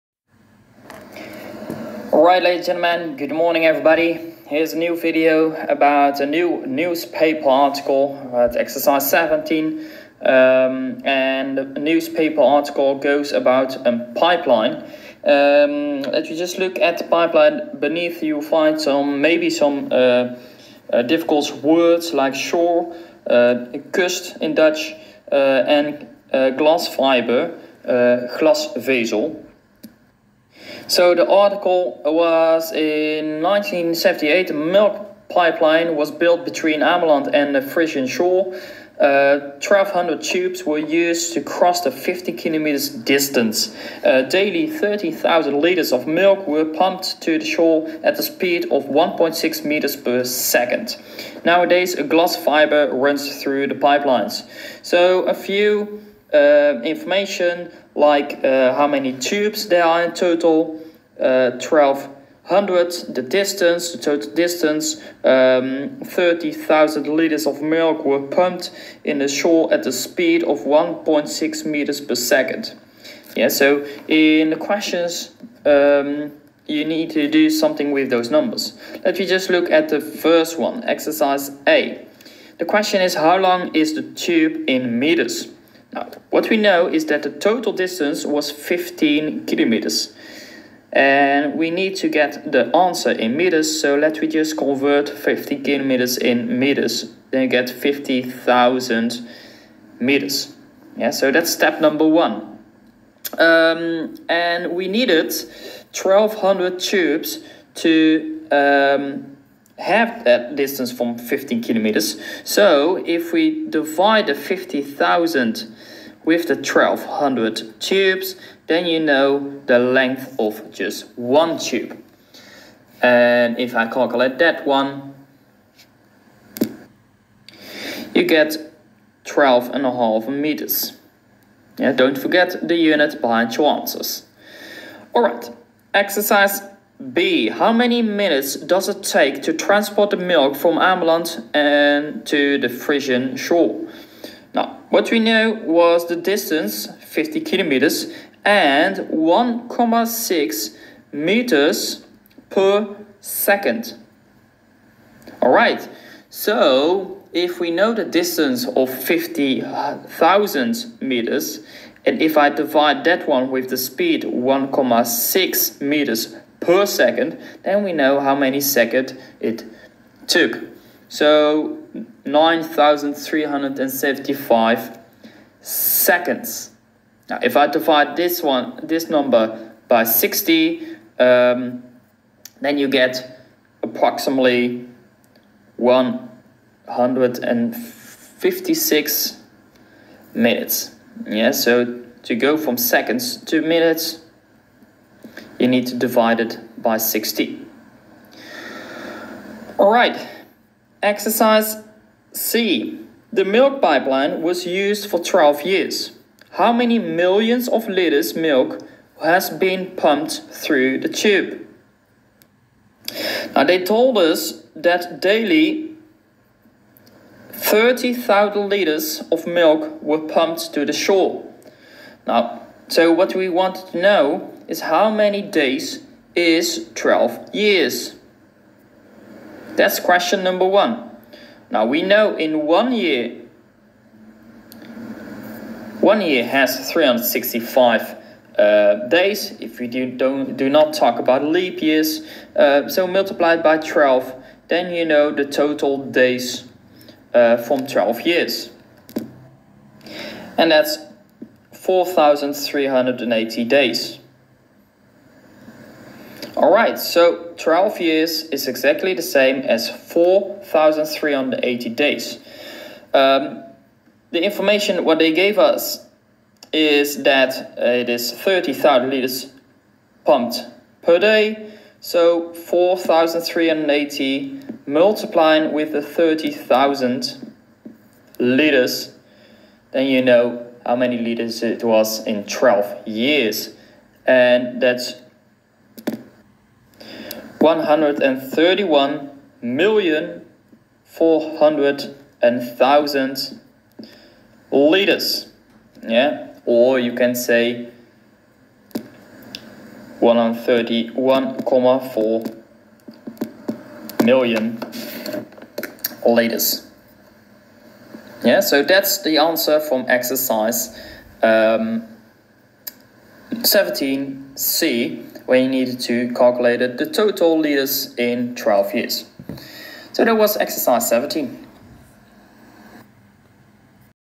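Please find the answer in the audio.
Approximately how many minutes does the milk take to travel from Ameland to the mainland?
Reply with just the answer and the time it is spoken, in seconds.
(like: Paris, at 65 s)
156 minutes, at 185 s.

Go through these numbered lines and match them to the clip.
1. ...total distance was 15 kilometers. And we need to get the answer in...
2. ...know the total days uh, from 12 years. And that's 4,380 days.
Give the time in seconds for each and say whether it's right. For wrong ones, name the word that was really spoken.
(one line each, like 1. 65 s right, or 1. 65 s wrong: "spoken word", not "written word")
1. 87 s right
2. 245 s right.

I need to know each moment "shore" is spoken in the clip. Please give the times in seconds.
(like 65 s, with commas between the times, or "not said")
22 s, 38 s, 47 s, 69 s, 143 s, 220 s.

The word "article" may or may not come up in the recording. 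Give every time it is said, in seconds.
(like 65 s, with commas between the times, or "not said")
7 s, 12 s, 31 s.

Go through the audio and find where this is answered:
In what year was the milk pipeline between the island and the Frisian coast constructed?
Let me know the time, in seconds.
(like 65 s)
33 s.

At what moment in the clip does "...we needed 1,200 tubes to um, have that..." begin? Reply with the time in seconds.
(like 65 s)
104 s.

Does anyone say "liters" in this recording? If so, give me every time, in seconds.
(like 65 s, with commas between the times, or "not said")
45 s, 67 s, 207 s, 218 s, 269 s, 278 s, 317 s.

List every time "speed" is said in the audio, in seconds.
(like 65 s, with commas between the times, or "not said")
48 s, 69 s, 163 s.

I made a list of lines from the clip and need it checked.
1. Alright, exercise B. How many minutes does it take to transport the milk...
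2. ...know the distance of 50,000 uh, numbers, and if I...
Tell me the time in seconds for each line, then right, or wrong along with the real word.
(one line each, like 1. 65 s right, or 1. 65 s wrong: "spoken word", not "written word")
1. 135 s right
2. 157 s wrong: "meters", not "numbers".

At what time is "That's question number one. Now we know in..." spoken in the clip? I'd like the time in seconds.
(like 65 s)
229 s.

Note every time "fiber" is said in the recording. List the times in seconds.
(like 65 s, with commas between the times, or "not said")
26 s, 52 s.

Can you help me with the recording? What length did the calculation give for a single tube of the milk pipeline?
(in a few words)
12.5 meters.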